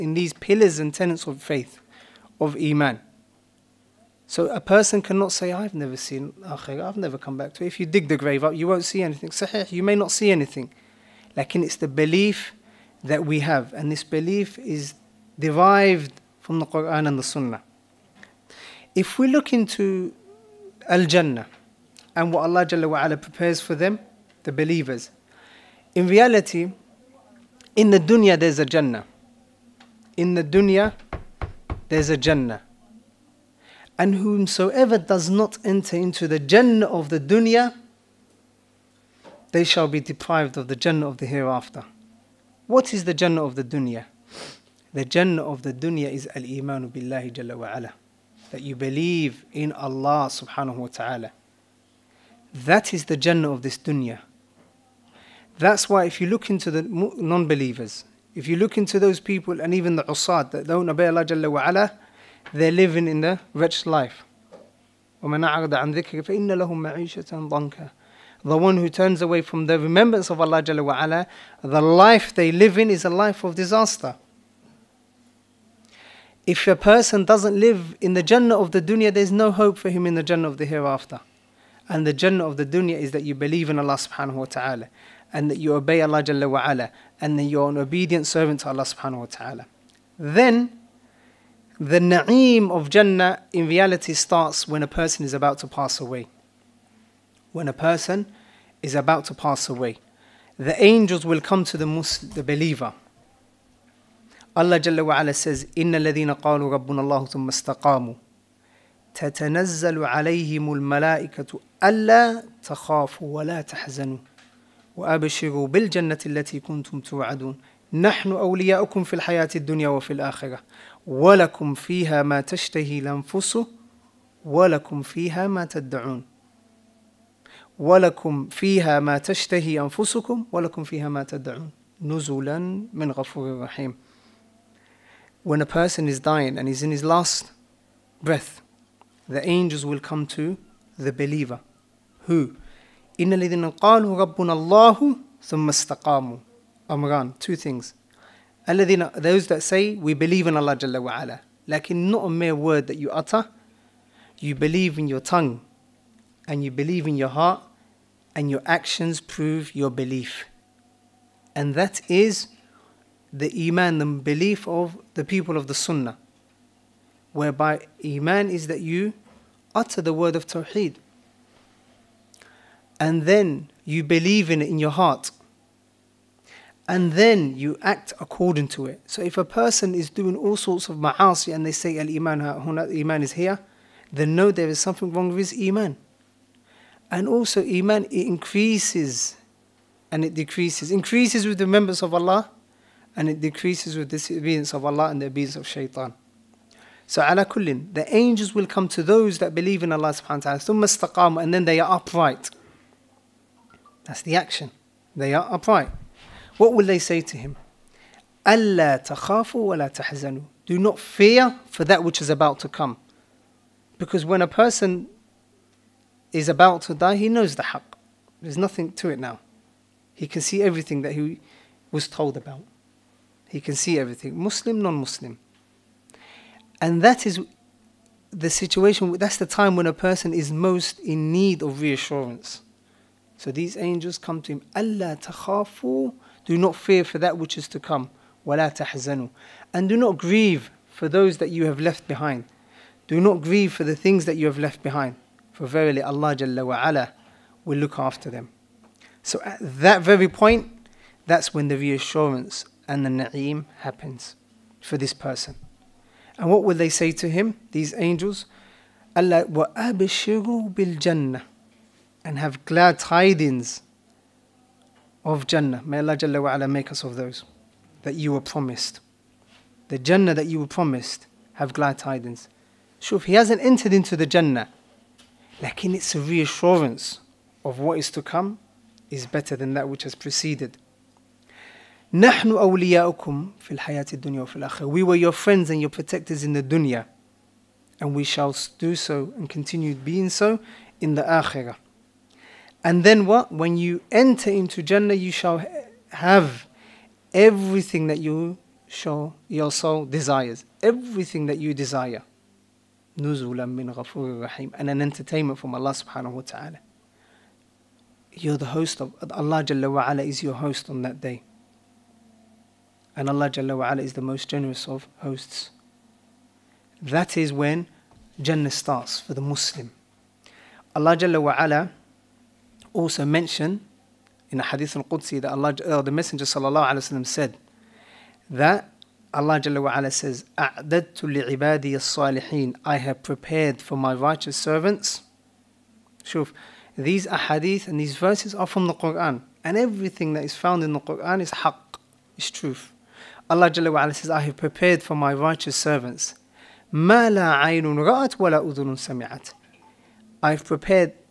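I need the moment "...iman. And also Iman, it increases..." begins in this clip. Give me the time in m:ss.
3:05.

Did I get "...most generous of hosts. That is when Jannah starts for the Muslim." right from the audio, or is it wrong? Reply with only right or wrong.
right.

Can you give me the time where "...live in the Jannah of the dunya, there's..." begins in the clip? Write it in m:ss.
1:17.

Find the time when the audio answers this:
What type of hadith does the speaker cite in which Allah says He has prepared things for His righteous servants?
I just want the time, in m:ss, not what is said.
5:24.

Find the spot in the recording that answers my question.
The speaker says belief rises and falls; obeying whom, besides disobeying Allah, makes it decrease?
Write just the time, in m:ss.
3:15.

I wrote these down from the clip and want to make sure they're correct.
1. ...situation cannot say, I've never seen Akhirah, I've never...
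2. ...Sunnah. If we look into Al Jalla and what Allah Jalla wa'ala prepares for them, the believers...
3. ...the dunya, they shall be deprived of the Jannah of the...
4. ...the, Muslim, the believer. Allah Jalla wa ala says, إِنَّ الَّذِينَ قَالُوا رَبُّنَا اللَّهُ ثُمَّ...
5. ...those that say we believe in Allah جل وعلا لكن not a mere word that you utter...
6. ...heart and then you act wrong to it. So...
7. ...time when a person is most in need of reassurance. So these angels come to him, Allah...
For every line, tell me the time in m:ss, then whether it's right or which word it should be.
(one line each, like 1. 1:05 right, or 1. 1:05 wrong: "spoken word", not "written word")
1. 0:04 wrong: "person", not "situation"
2. 0:17 wrong: "Jannah", not "Jalla"
3. 0:37 right
4. 1:41 right
5. 2:29 right
6. 2:54 wrong: "according", not "wrong"
7. 3:49 right.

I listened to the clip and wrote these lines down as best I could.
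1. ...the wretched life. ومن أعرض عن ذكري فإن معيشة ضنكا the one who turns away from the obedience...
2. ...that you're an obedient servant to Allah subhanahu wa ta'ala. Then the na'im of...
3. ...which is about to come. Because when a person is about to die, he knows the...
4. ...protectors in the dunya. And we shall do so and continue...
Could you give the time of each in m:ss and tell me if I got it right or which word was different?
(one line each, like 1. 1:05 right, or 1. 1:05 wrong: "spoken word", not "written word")
1. 1:03 wrong: "remembrance", not "obedience"
2. 1:27 right
3. 3:32 right
4. 4:45 right.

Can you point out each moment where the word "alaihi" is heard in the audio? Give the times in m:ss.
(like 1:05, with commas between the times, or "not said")
5:26.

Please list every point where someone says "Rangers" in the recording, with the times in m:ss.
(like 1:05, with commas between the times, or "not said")
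not said.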